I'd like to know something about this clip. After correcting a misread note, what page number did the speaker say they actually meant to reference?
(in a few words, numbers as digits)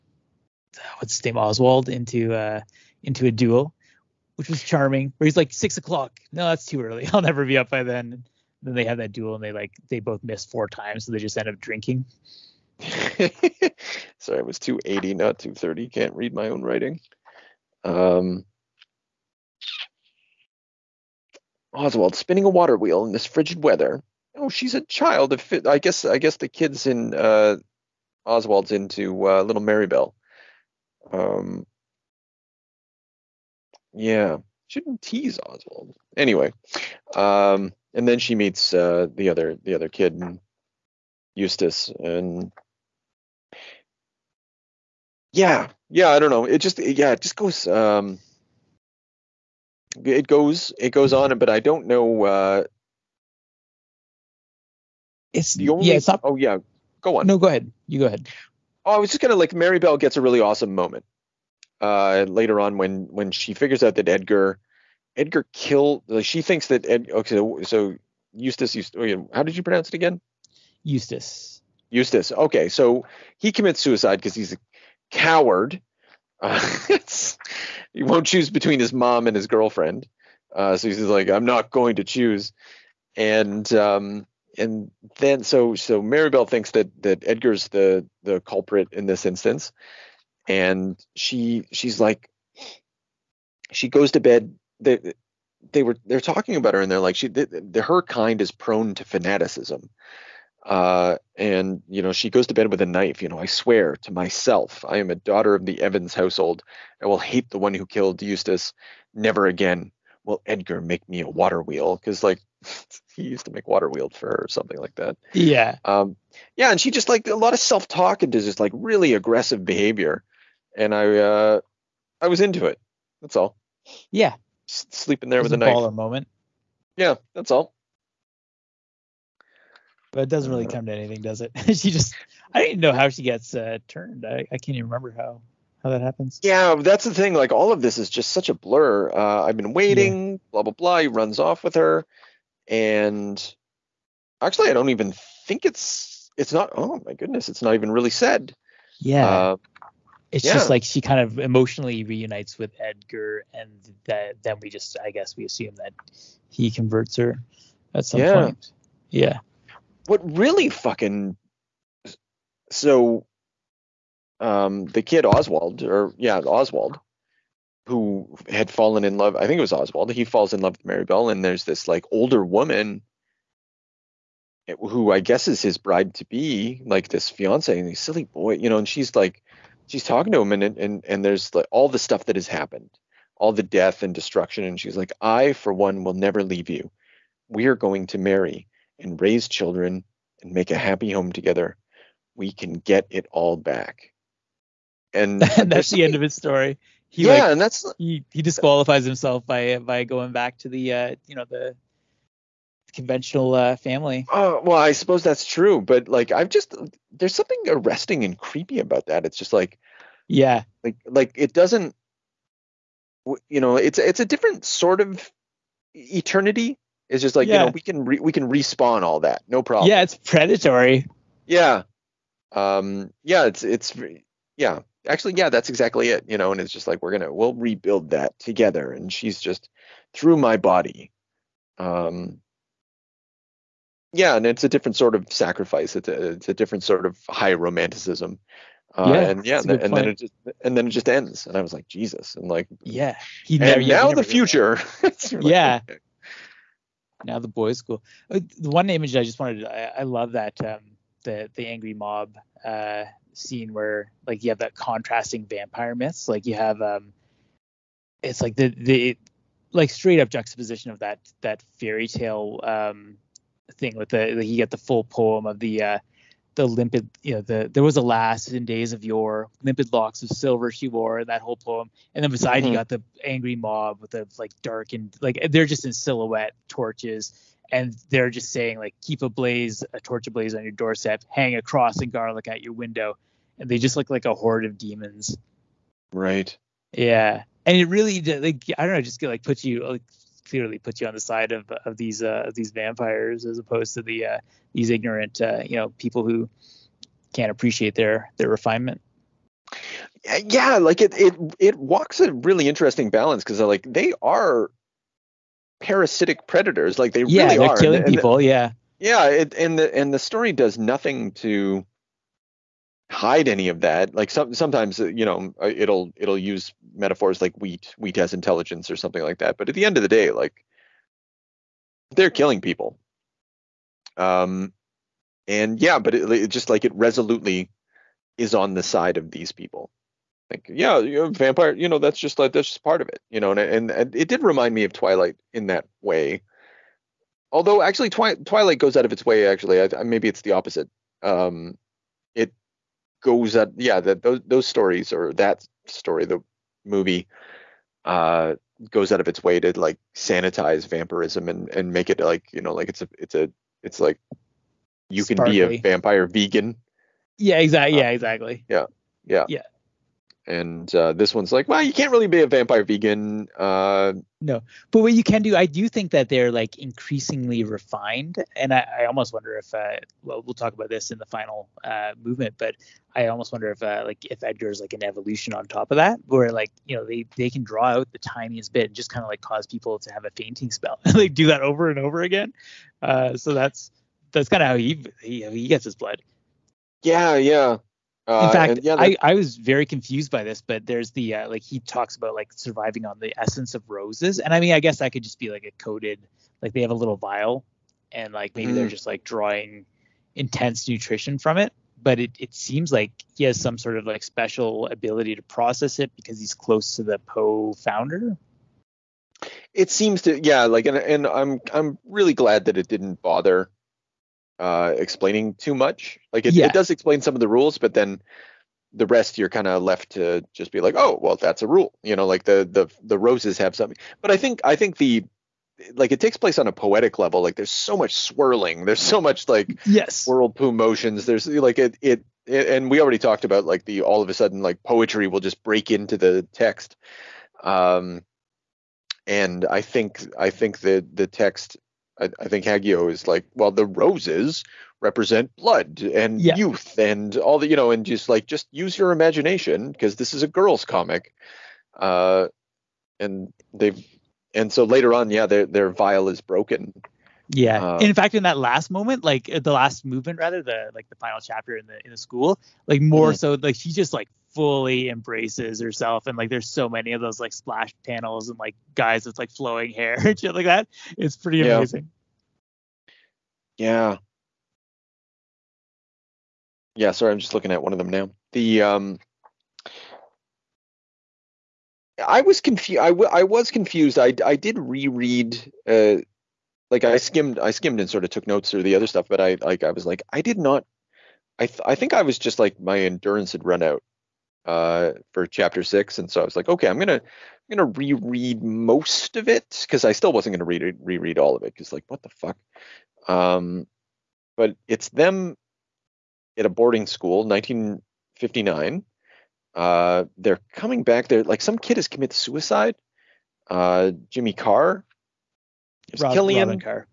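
280.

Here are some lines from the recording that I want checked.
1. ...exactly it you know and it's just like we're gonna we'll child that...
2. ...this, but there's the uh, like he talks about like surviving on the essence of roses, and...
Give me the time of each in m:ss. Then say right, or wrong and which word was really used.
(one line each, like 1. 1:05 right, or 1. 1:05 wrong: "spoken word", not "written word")
1. 3:45 wrong: "rebuild", not "child"
2. 6:30 right.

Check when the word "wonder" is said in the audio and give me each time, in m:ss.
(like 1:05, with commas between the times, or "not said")
6:09, 6:13.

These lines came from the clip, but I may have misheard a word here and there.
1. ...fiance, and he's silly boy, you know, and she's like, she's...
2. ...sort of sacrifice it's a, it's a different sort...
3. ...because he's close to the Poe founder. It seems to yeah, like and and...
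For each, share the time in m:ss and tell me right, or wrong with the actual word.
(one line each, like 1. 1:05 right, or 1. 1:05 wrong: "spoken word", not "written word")
1. 2:57 right
2. 3:54 right
3. 6:46 right.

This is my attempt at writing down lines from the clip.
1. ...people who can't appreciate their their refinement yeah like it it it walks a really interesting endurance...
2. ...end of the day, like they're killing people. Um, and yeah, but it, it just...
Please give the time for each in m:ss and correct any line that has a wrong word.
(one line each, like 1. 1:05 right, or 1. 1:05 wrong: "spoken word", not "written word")
1. 4:55 wrong: "balance", not "endurance"
2. 5:19 right.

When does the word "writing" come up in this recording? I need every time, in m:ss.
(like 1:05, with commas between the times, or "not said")
0:16.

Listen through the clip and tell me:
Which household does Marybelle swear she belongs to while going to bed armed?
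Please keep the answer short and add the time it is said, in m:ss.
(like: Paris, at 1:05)
Evans, at 1:45.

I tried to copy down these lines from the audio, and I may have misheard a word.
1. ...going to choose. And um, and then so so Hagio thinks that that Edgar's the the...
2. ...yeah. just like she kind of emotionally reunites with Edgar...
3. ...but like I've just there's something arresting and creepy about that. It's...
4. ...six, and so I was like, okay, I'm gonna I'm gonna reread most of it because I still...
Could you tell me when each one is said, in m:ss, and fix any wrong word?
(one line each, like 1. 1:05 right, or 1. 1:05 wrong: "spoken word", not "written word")
1. 1:21 wrong: "Marybelle", not "Hagio"
2. 2:30 right
3. 3:25 right
4. 8:15 right.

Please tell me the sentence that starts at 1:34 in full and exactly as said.
They they were they're talking about her and they're like she the, the, her kind is prone to fanaticism.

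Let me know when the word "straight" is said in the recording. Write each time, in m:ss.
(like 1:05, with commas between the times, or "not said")
4:19.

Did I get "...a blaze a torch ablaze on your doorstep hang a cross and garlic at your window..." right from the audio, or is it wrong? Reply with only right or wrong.
right.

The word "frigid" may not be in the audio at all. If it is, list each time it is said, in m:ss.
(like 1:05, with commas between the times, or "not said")
0:23.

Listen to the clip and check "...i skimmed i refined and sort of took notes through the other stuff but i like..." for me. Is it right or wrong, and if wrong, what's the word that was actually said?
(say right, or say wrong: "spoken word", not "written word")
wrong: "skimmed", not "refined".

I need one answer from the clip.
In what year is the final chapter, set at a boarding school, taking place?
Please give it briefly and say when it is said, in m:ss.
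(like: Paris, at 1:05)
1959, at 8:27.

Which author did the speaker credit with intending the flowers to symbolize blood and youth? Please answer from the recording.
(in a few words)
Hagio.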